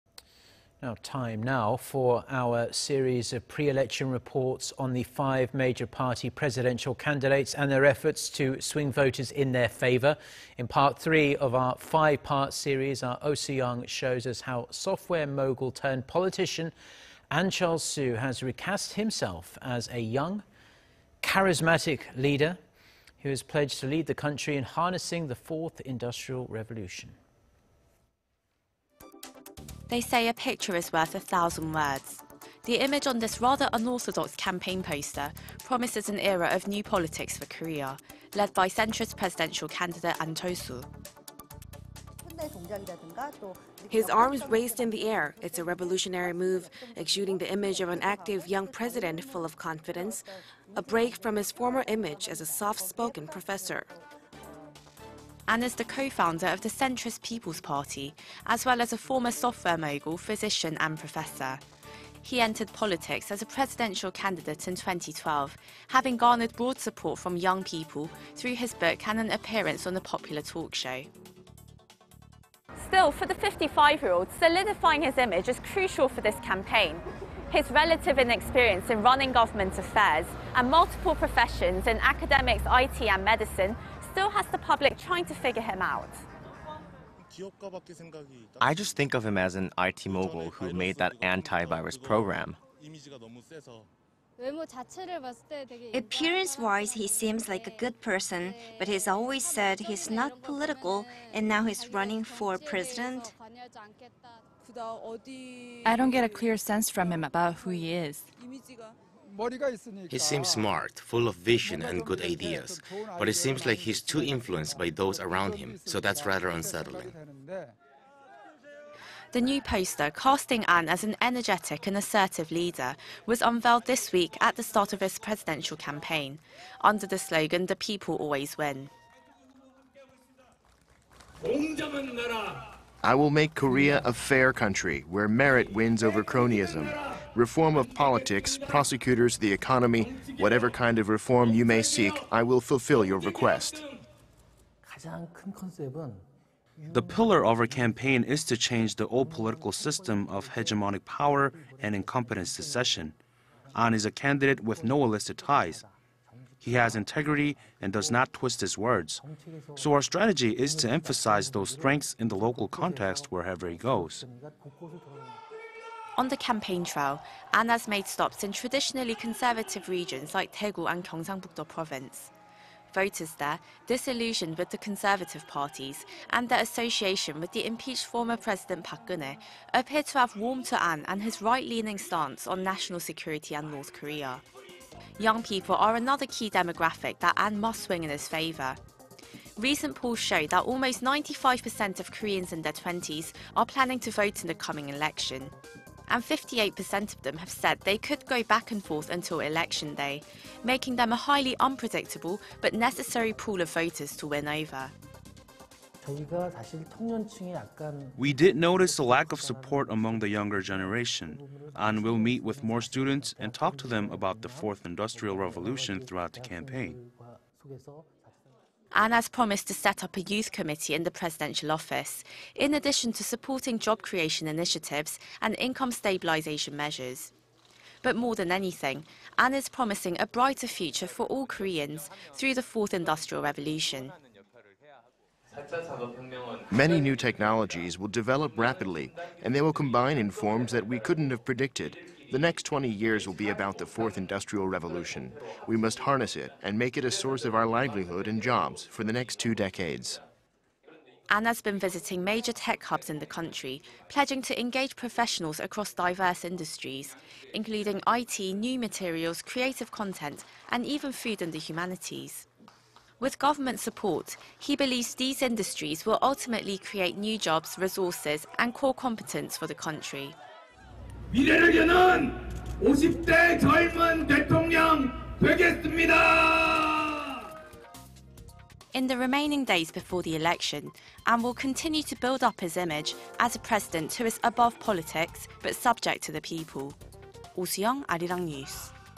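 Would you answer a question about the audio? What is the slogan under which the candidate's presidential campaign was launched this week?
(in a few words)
The People Always Win.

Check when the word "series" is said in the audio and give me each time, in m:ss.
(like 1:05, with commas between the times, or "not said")
0:02, 0:12.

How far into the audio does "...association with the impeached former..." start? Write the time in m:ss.
2:56.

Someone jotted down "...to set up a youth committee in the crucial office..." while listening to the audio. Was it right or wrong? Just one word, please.
wrong.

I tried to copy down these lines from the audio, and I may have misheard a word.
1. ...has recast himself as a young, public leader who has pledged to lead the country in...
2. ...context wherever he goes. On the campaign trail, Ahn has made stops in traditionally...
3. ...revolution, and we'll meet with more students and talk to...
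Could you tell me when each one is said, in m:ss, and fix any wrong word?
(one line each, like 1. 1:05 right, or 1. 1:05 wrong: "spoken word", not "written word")
1. 0:18 wrong: "charismatic", not "public"
2. 2:42 right
3. 3:30 wrong: "generation", not "revolution".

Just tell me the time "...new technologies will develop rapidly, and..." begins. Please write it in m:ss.
3:57.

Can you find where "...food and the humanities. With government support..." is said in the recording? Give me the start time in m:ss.
4:21.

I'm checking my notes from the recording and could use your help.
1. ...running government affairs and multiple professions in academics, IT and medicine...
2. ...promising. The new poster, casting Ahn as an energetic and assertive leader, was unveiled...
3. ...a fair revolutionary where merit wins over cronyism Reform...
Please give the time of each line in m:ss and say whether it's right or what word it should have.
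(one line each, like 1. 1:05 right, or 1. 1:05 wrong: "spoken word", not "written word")
1. 1:19 right
2. 1:56 wrong: "unsettling", not "promising"
3. 2:14 wrong: "country", not "revolutionary".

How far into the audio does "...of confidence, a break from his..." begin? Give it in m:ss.
0:49.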